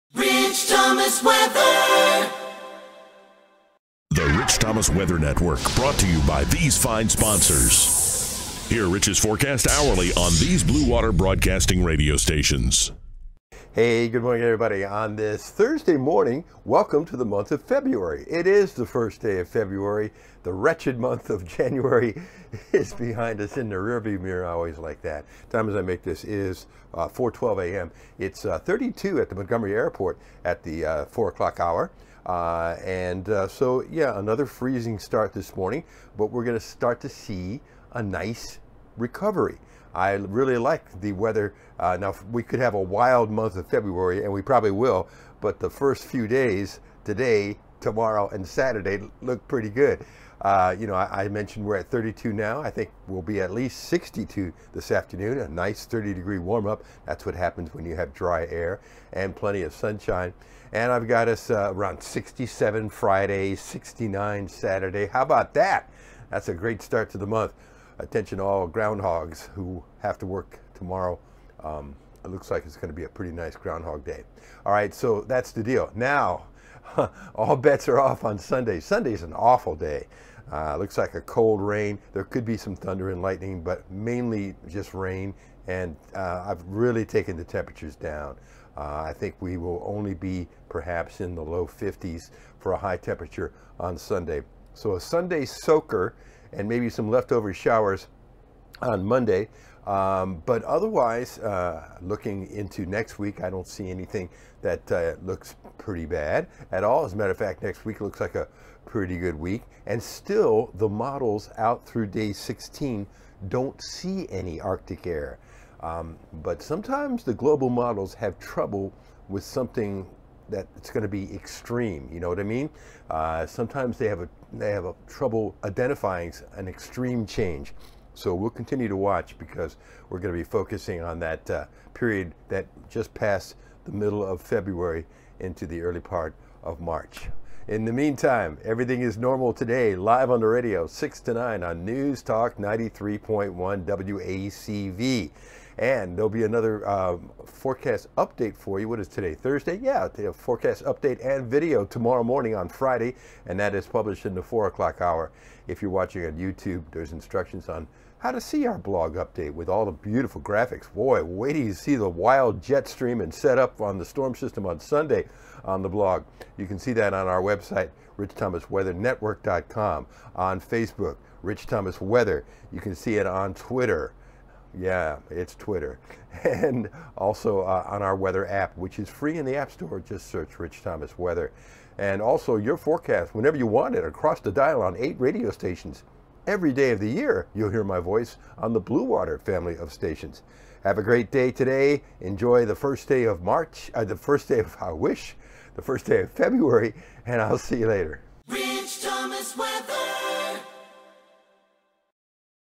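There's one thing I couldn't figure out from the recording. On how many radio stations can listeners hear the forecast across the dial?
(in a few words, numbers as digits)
8.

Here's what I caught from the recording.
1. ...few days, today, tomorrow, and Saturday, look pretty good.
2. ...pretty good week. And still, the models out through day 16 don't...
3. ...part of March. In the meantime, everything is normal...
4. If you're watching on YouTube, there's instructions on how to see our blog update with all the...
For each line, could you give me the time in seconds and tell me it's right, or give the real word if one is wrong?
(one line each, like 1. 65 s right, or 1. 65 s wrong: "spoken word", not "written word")
1. 46 s right
2. 108 s right
3. 136 s right
4. 155 s right.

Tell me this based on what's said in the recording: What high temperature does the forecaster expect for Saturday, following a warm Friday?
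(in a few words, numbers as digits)
69.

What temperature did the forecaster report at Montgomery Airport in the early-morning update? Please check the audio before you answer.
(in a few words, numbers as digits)
32.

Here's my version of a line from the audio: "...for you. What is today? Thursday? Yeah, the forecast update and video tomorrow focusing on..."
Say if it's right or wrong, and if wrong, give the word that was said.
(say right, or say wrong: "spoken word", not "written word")
wrong: "morning", not "focusing".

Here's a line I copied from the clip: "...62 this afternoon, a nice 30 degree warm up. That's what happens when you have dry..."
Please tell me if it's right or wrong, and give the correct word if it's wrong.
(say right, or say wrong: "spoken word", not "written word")
right.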